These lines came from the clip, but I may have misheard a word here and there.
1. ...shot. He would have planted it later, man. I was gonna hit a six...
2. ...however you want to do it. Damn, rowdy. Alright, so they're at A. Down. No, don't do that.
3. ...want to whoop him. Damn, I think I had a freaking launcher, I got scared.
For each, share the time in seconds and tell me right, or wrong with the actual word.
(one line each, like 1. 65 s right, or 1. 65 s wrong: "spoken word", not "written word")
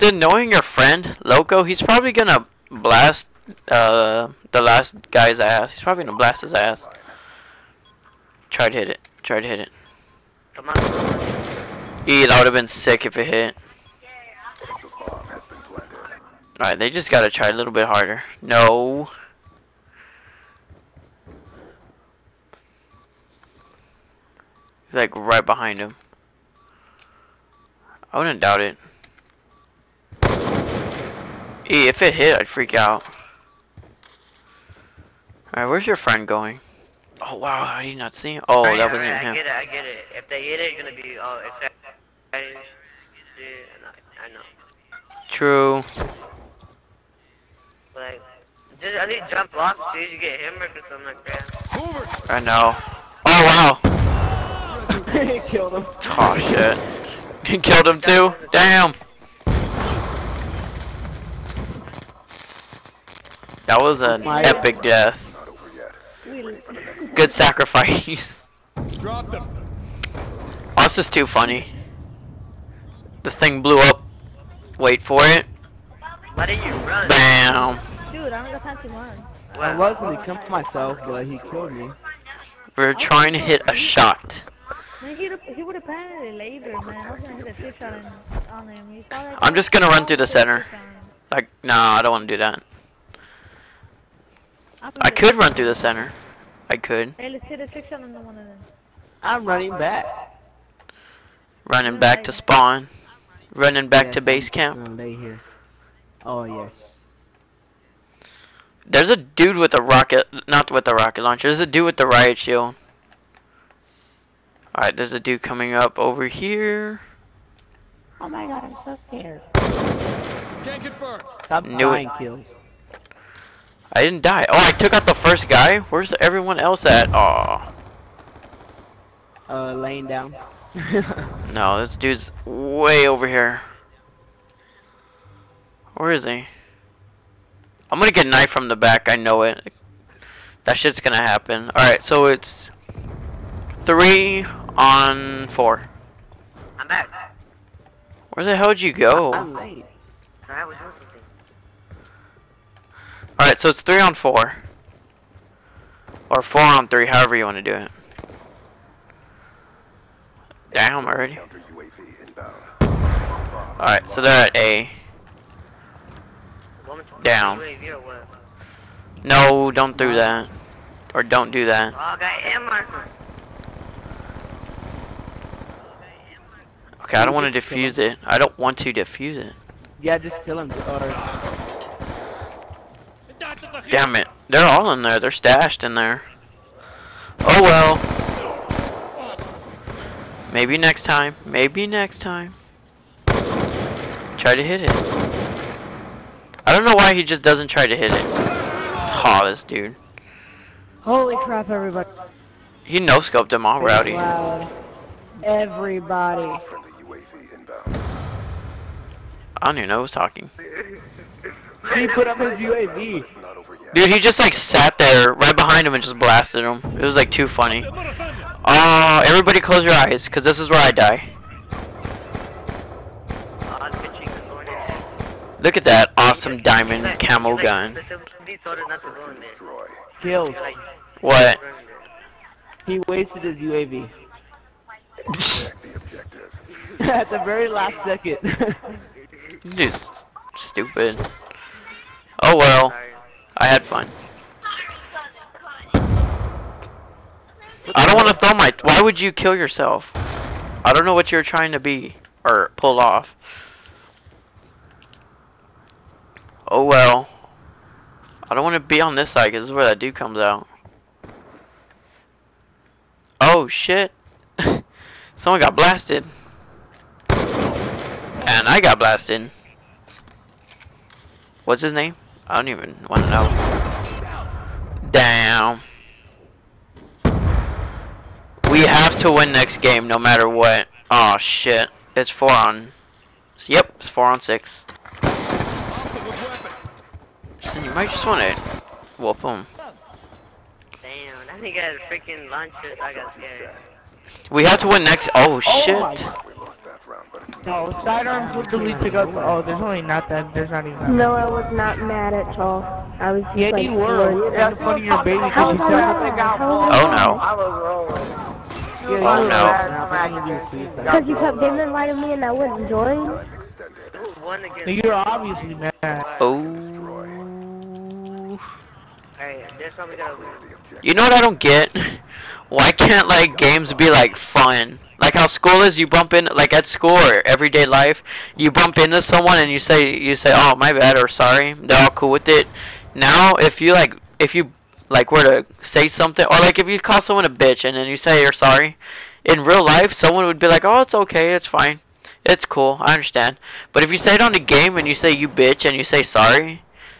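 1. 83 s right
2. 157 s wrong: "already", not "rowdy"
3. 288 s right.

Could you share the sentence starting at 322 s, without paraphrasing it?
Why can't like games be like fun?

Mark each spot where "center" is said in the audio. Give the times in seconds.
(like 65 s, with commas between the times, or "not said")
90 s, 95 s.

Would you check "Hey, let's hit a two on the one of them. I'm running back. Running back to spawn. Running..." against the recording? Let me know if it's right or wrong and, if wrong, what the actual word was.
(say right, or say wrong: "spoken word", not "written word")
wrong: "six", not "two".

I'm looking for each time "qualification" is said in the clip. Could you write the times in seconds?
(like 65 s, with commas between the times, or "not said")
not said.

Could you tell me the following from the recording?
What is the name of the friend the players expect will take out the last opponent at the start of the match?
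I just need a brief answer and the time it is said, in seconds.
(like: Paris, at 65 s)
Loco, at 1 s.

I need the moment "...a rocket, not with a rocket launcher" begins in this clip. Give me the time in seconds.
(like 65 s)
109 s.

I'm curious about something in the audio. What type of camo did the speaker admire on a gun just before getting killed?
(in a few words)
diamond.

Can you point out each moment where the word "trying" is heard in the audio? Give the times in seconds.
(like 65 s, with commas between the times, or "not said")
82 s, 251 s.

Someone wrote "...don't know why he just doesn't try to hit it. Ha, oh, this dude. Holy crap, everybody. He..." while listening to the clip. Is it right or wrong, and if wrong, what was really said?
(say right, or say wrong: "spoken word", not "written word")
right.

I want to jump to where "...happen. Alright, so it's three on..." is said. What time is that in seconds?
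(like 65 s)
141 s.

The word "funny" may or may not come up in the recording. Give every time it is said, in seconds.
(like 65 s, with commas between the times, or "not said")
71 s, 217 s.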